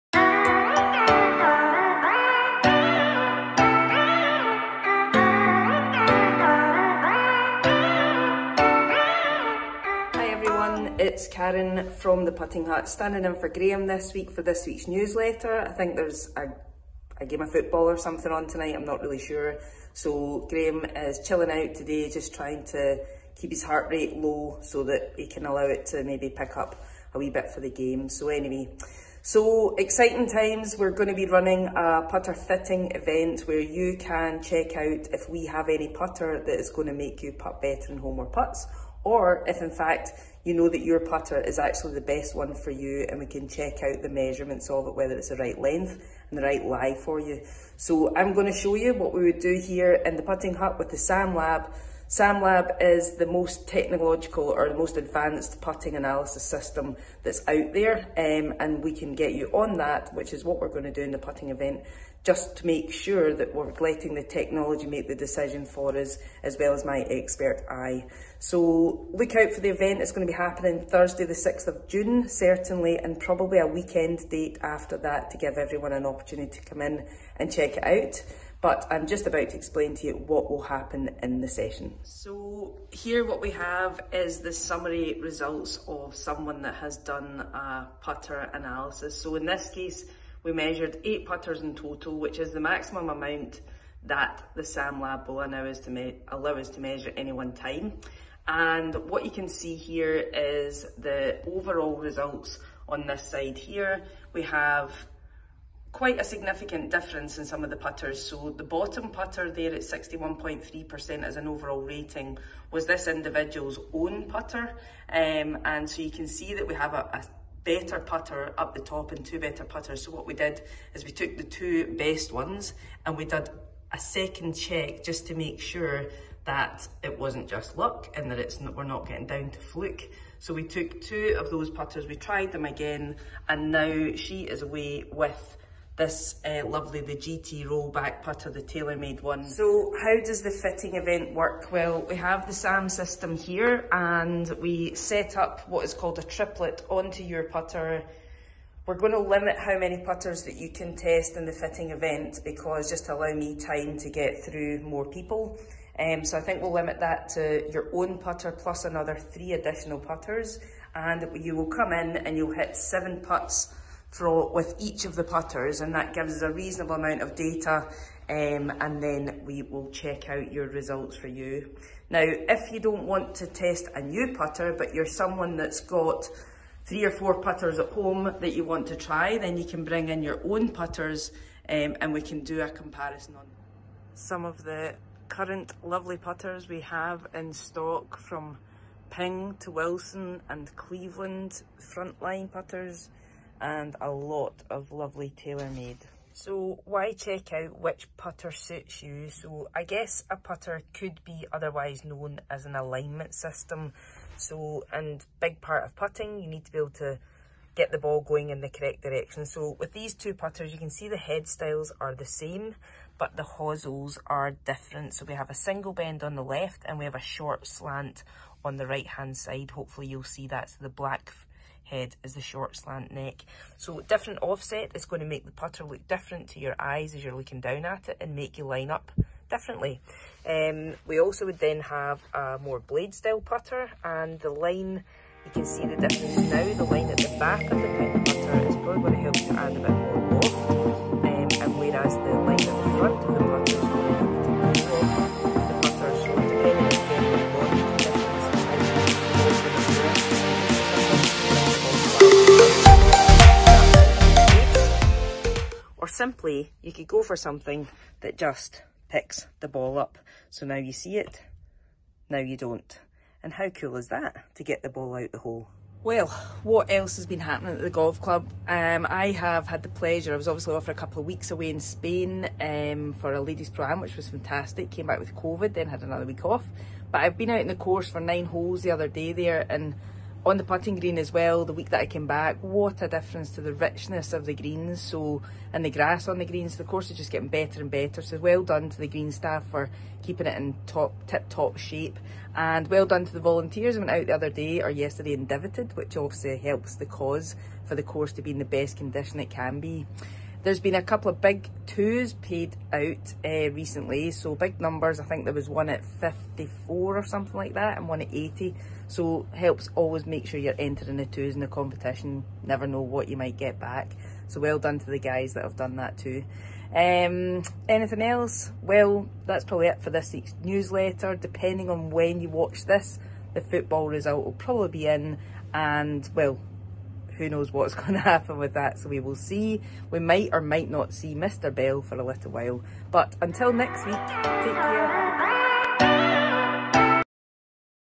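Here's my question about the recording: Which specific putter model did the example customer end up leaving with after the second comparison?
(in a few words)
GT rollback.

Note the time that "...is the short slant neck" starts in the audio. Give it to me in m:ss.
3:42.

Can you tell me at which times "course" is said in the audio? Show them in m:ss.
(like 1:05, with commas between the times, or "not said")
4:37, 4:46, 4:58.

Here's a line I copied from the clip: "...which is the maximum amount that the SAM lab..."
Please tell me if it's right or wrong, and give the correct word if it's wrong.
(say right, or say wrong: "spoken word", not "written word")
right.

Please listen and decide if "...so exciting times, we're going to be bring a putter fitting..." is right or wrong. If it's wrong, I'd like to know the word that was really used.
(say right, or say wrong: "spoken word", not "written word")
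wrong: "running", not "bring".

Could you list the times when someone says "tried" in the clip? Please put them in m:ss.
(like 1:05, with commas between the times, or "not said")
2:12.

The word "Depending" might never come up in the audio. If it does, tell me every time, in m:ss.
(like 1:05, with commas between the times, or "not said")
5:21.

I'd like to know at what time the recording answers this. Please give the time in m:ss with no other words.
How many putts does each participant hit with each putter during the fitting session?
2:42.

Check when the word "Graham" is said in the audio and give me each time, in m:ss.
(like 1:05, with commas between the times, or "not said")
0:13, 0:20.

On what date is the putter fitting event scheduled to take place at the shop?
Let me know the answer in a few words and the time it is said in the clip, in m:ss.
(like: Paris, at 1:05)
Thursday, 6 June, at 1:10.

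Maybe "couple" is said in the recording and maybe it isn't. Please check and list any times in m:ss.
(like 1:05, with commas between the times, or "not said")
4:31, 5:01.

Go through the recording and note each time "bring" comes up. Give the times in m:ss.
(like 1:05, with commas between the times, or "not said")
2:59.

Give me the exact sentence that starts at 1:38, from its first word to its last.
And what you can see here is the overall results on this side here.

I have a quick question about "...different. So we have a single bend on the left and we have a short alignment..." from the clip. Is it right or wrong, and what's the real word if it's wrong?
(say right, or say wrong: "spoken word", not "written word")
wrong: "slant", not "alignment".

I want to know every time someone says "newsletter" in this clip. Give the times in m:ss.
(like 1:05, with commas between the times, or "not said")
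0:14, 5:20.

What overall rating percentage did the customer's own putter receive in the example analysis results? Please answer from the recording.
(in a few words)
61.3%.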